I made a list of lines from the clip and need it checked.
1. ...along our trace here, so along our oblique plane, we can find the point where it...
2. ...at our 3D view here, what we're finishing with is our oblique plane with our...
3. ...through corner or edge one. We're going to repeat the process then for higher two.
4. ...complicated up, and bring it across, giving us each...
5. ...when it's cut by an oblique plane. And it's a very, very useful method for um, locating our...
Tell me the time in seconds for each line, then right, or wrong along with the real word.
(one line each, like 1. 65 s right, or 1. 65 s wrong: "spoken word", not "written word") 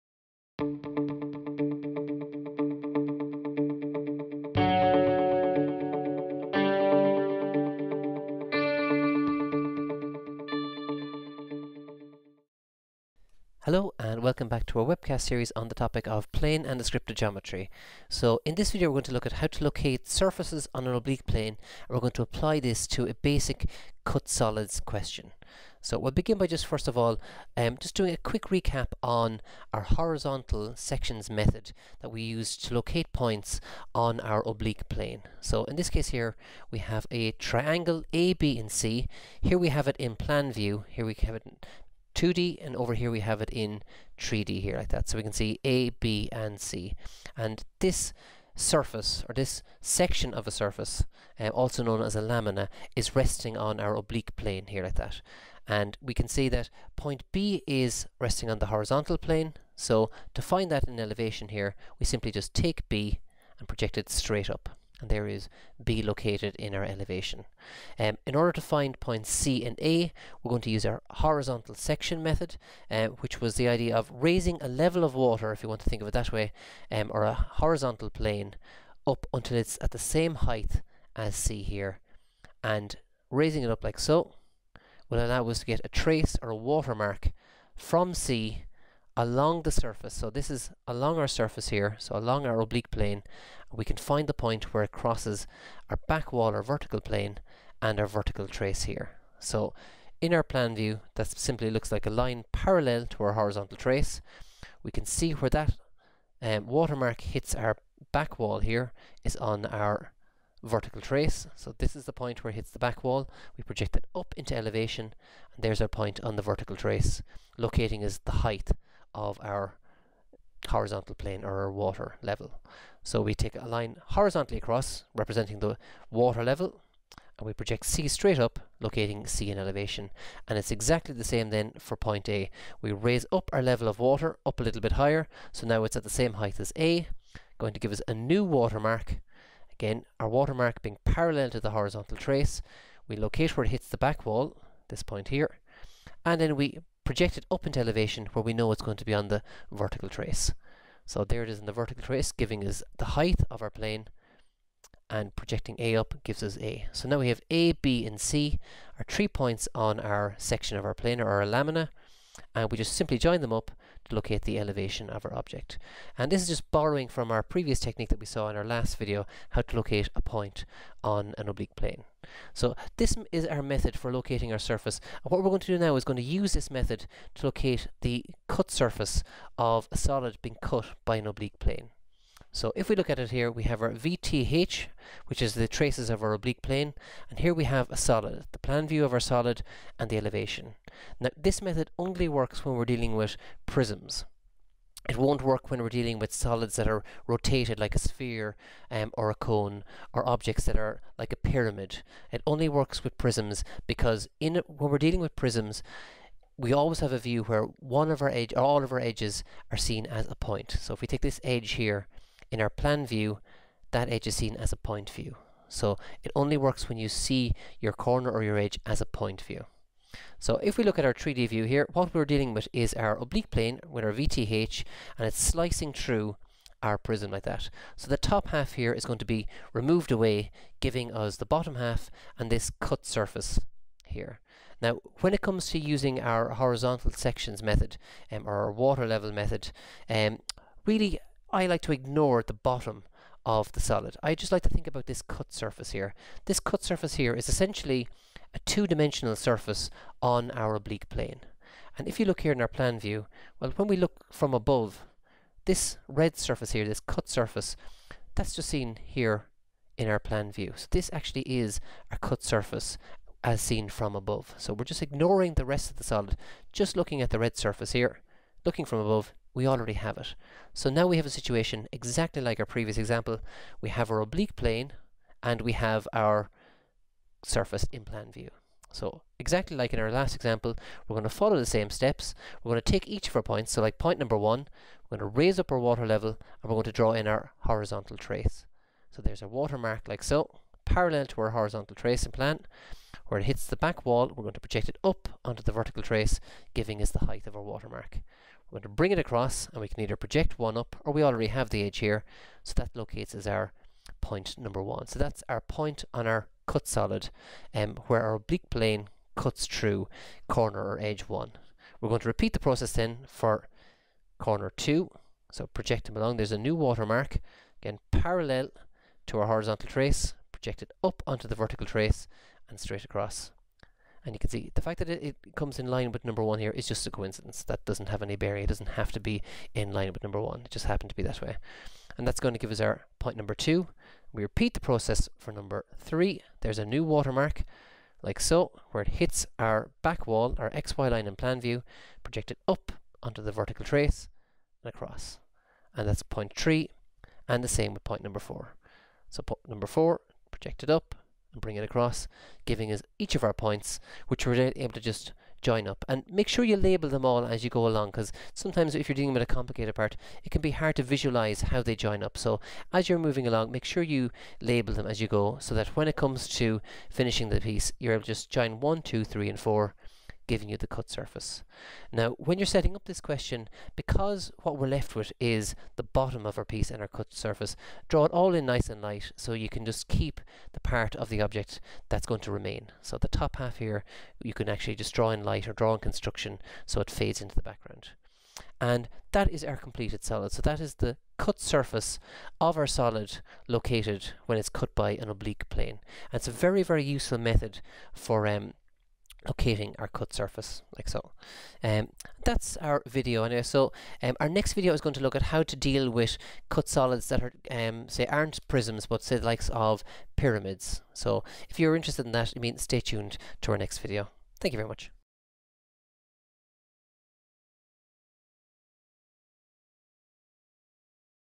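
1. 90 s wrong: "surface", not "trace"
2. 220 s wrong: "dealing", not "finishing"
3. 309 s wrong: "corner", not "higher"
4. 350 s wrong: "projected", not "complicated"
5. 394 s right.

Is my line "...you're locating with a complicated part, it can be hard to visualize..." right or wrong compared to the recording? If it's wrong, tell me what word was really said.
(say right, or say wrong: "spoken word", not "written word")
wrong: "dealing", not "locating".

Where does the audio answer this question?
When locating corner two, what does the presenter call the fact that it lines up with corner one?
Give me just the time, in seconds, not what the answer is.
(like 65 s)
326 s.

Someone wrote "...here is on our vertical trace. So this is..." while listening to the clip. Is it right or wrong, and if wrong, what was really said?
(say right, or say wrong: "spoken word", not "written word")
right.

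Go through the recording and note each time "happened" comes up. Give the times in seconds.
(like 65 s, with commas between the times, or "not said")
330 s.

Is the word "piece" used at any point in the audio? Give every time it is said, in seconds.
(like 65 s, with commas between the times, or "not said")
367 s, 376 s.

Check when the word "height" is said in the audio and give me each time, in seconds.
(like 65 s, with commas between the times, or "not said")
80 s, 118 s, 136 s, 153 s, 297 s.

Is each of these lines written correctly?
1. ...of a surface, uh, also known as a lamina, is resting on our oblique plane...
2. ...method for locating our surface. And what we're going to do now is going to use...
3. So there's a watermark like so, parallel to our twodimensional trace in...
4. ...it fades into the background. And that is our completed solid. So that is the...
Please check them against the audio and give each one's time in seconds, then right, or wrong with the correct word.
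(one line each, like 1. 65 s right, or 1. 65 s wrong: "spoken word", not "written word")
1. 50 s right
2. 173 s right
3. 289 s wrong: "horizontal", not "twodimensional"
4. 386 s right.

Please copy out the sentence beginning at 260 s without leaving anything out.
So this actually is a cut surface as seen from above.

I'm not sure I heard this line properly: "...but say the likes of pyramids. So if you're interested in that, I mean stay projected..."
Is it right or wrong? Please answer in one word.
wrong.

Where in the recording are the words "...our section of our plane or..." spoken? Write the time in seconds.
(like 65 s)
159 s.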